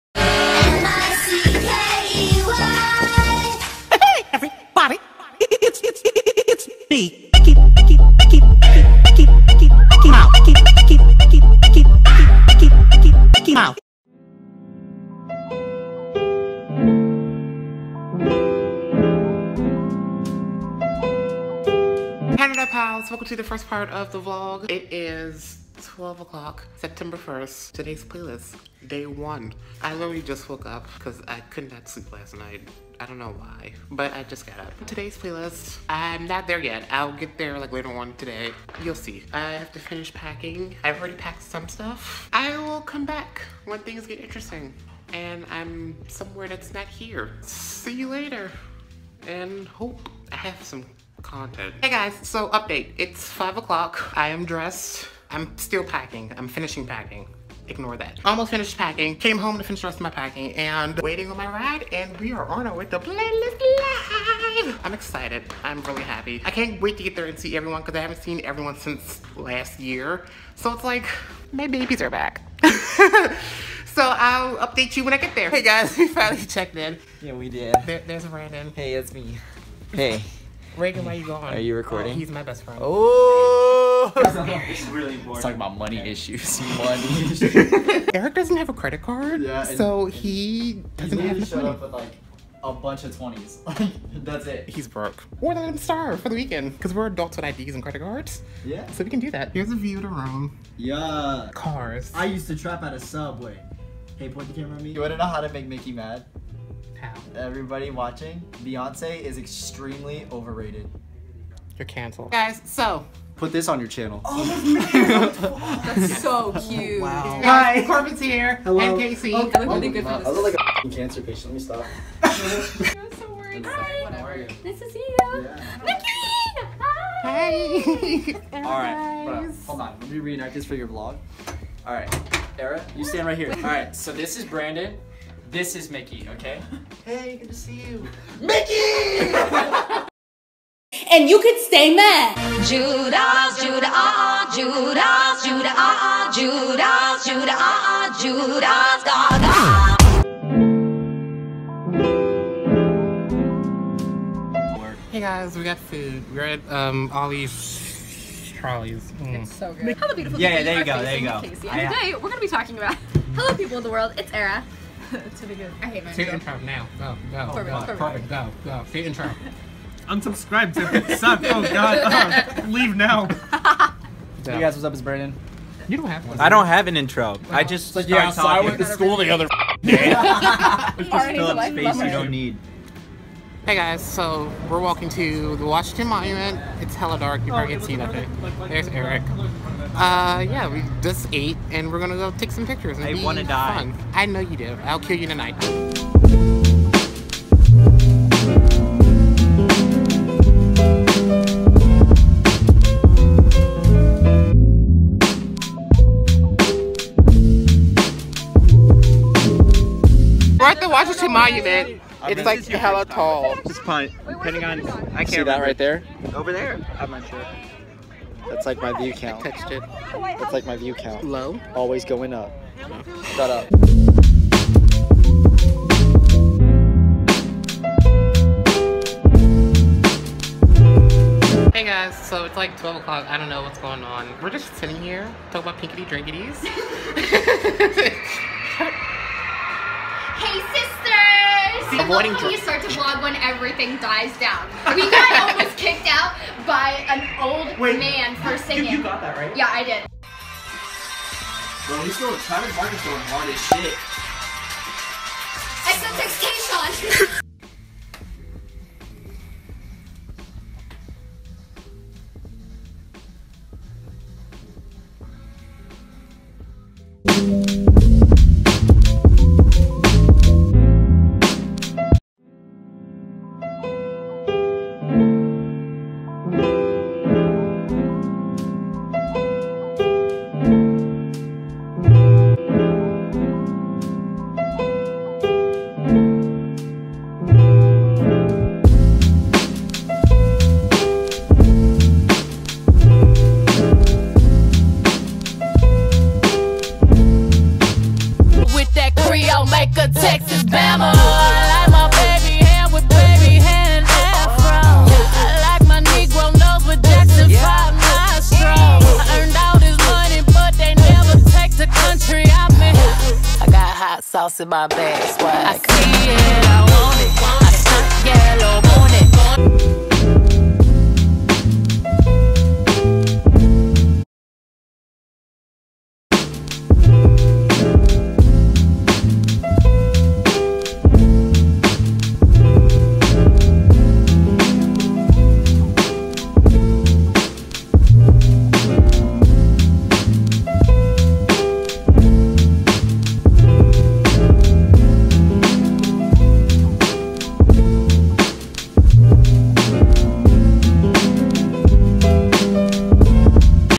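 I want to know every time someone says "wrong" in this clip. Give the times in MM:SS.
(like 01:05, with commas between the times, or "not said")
not said.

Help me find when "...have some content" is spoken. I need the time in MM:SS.
00:50.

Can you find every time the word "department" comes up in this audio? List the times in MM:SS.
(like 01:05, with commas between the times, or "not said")
not said.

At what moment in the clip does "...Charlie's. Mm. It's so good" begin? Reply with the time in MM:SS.
02:38.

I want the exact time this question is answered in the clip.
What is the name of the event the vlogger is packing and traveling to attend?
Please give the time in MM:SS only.
01:02.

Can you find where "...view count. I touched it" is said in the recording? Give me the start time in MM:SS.
03:38.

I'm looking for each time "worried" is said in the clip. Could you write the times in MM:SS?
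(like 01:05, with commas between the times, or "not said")
02:03.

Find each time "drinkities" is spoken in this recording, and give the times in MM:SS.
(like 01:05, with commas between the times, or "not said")
03:56.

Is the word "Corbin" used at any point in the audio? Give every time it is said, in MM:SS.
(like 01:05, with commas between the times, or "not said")
01:57, 02:47.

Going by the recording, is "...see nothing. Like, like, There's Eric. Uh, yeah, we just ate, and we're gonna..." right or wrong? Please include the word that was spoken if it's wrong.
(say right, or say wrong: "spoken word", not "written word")
right.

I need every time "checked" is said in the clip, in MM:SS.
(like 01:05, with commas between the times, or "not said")
01:16.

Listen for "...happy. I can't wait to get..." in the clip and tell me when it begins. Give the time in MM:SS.
01:06.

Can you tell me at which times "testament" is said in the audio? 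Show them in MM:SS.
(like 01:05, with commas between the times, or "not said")
not said.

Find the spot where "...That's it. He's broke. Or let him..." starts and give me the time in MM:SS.
01:34.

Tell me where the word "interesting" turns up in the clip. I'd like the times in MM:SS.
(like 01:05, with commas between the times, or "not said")
00:44.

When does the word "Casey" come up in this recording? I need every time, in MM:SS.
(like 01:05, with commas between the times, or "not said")
01:58, 02:41.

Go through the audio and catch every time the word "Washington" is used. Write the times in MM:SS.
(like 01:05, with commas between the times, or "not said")
03:05, 03:30.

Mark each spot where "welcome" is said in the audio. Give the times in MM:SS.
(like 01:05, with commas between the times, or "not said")
00:23.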